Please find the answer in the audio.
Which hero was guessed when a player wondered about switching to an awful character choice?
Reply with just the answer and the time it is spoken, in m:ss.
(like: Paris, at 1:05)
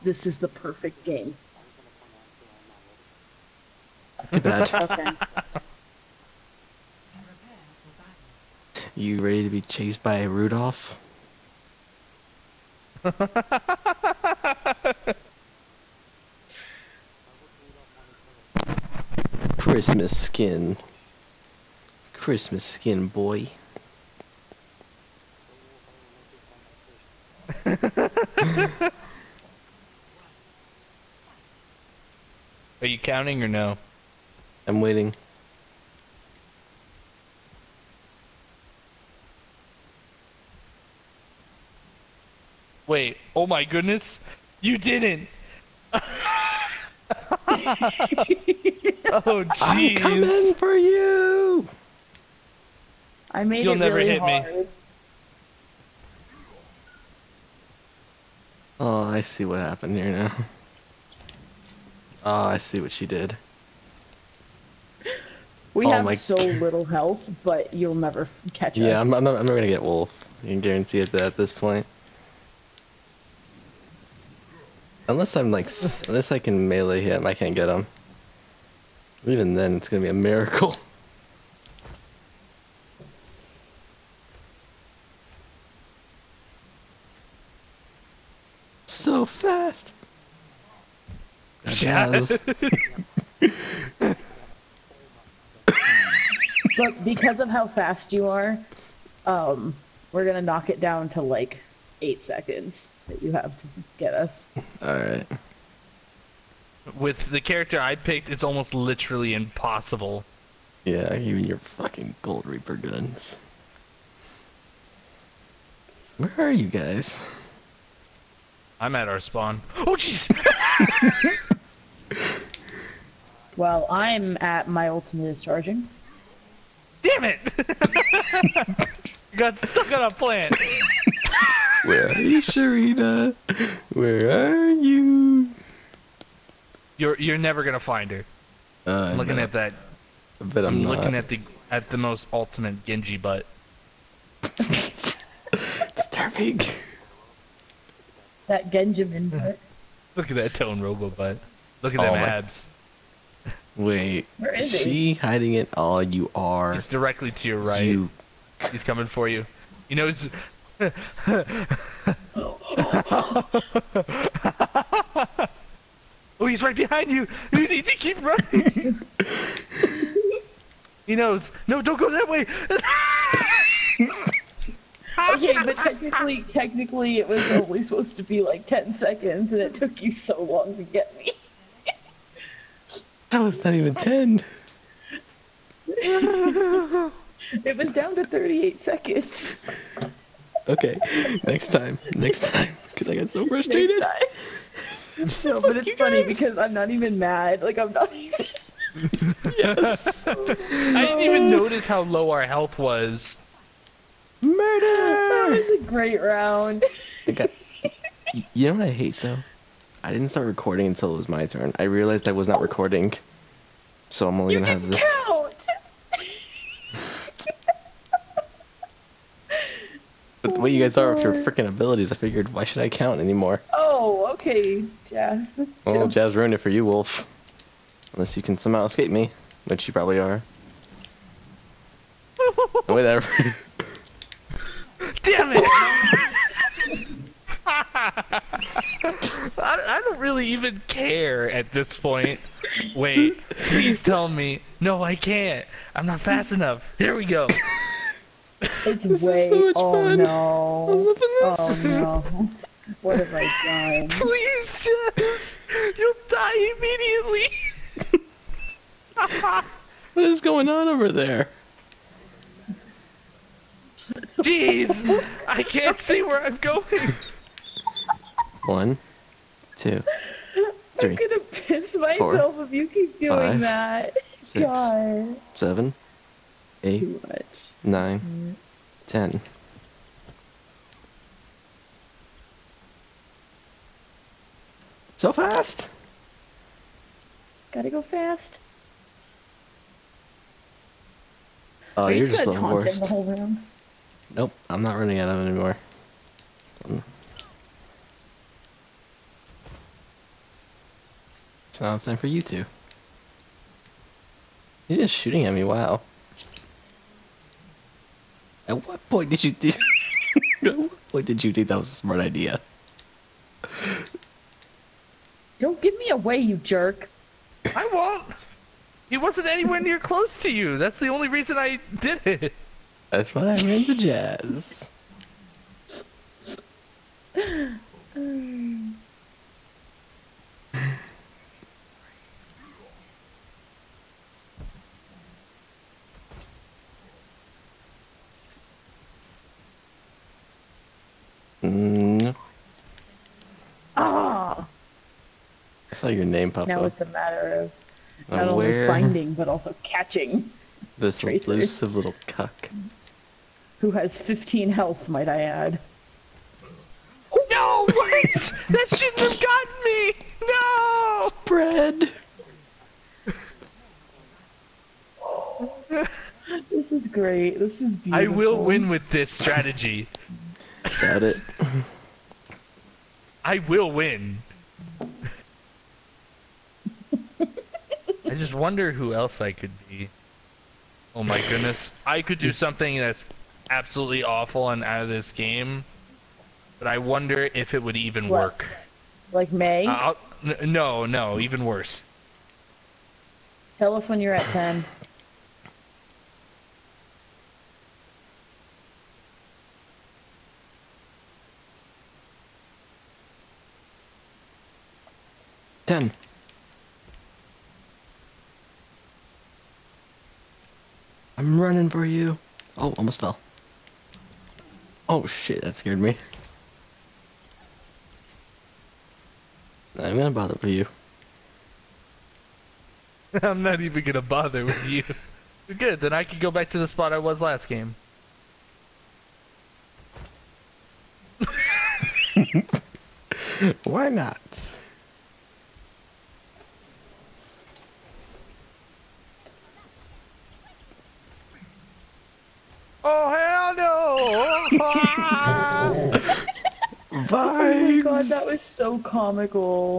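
Mei, at 6:29.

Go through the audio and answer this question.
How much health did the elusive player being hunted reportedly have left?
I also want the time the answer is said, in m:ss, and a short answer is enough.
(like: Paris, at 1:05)
15, at 5:54.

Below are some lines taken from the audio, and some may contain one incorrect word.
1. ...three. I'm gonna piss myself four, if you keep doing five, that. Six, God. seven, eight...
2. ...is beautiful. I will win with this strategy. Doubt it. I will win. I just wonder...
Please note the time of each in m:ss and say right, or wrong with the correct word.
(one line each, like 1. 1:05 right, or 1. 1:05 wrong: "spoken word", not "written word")
1. 4:30 right
2. 6:07 right.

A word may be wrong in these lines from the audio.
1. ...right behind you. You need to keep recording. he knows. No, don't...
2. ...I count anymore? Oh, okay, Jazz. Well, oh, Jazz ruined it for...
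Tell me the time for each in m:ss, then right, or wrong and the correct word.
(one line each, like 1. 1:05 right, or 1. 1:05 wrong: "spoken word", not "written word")
1. 2:46 wrong: "running", not "recording"
2. 3:42 right.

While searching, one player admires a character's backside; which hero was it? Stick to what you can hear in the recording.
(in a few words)
Genji.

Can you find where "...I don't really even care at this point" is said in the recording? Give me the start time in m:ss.
3:59.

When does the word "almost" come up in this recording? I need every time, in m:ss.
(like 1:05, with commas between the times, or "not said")
1:48, 6:52.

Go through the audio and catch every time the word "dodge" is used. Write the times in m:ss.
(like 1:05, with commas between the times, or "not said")
not said.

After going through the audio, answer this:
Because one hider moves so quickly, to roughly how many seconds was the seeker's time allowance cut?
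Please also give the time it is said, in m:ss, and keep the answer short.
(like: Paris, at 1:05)
8, at 1:42.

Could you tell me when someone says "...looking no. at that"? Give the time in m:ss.
2:19.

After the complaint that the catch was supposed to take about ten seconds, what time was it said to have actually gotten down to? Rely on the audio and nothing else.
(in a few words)
38 seconds.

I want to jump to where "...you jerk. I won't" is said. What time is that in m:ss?
5:16.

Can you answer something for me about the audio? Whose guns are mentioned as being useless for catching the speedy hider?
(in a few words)
Gold Reaper.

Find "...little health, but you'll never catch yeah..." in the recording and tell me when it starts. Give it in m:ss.
1:06.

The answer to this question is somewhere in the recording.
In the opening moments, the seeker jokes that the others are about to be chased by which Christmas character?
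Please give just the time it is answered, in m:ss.
0:10.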